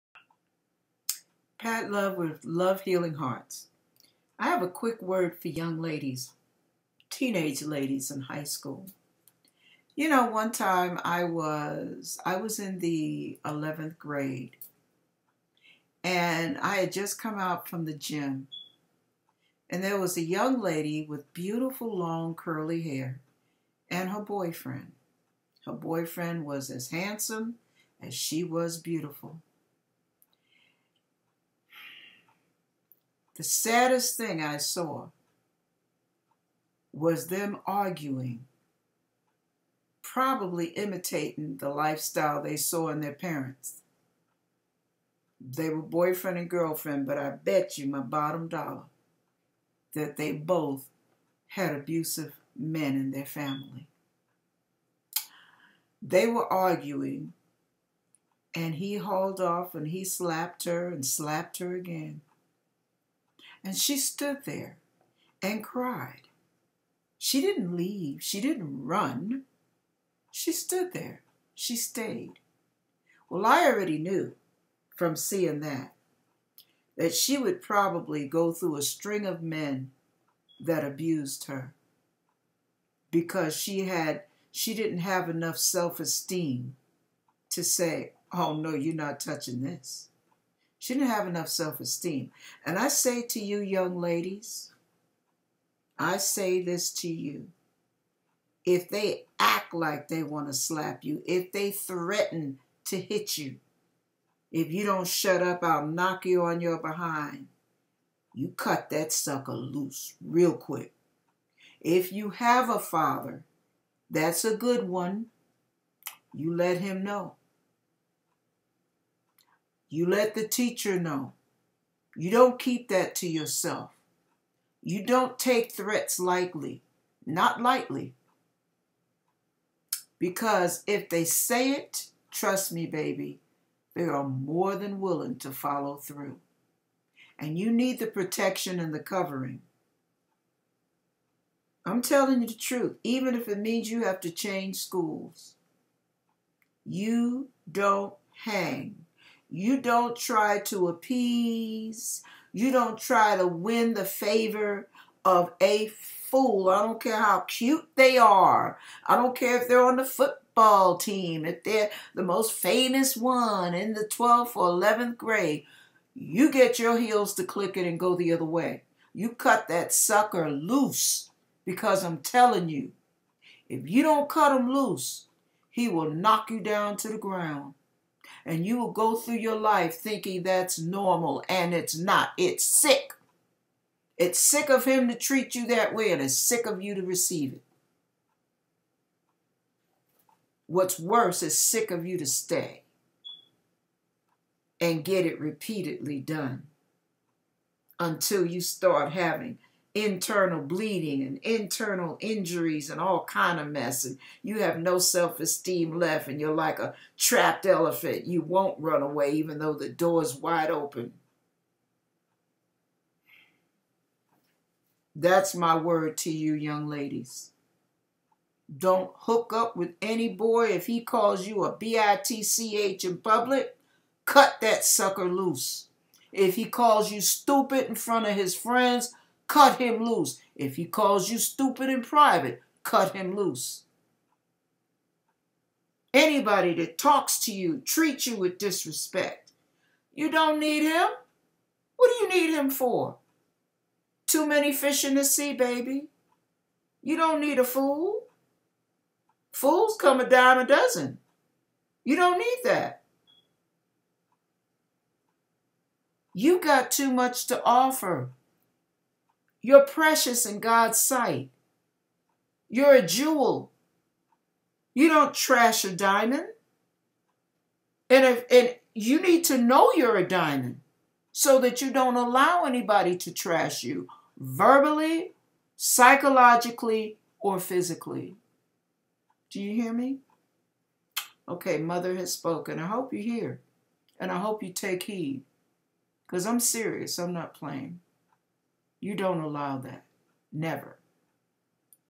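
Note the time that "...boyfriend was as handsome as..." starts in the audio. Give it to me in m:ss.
0:25.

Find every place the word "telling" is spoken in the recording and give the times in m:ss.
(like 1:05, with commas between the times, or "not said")
2:22, 2:52.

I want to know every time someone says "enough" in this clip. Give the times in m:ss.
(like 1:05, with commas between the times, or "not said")
1:25, 1:31.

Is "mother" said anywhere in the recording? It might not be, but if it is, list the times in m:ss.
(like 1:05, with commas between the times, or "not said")
4:41.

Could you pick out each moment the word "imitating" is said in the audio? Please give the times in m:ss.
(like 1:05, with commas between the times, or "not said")
0:40.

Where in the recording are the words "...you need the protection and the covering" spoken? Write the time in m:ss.
2:17.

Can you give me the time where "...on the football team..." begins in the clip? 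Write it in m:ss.
2:39.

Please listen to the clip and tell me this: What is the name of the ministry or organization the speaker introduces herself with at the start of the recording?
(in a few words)
Love Healing Hearts.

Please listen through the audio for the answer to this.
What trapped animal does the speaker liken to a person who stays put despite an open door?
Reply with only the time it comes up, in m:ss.
3:27.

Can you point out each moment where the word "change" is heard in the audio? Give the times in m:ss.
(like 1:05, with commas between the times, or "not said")
2:24.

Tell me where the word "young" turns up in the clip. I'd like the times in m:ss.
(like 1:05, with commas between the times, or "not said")
0:05, 0:20, 1:33, 3:36.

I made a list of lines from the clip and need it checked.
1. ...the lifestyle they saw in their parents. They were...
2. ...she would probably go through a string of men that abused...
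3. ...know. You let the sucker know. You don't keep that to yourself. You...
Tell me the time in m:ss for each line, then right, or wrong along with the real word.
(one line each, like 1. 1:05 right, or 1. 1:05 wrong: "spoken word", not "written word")
1. 0:41 right
2. 1:17 right
3. 1:57 wrong: "teacher", not "sucker".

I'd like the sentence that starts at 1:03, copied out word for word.
And she stood there and cried.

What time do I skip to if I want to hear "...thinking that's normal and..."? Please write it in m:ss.
2:59.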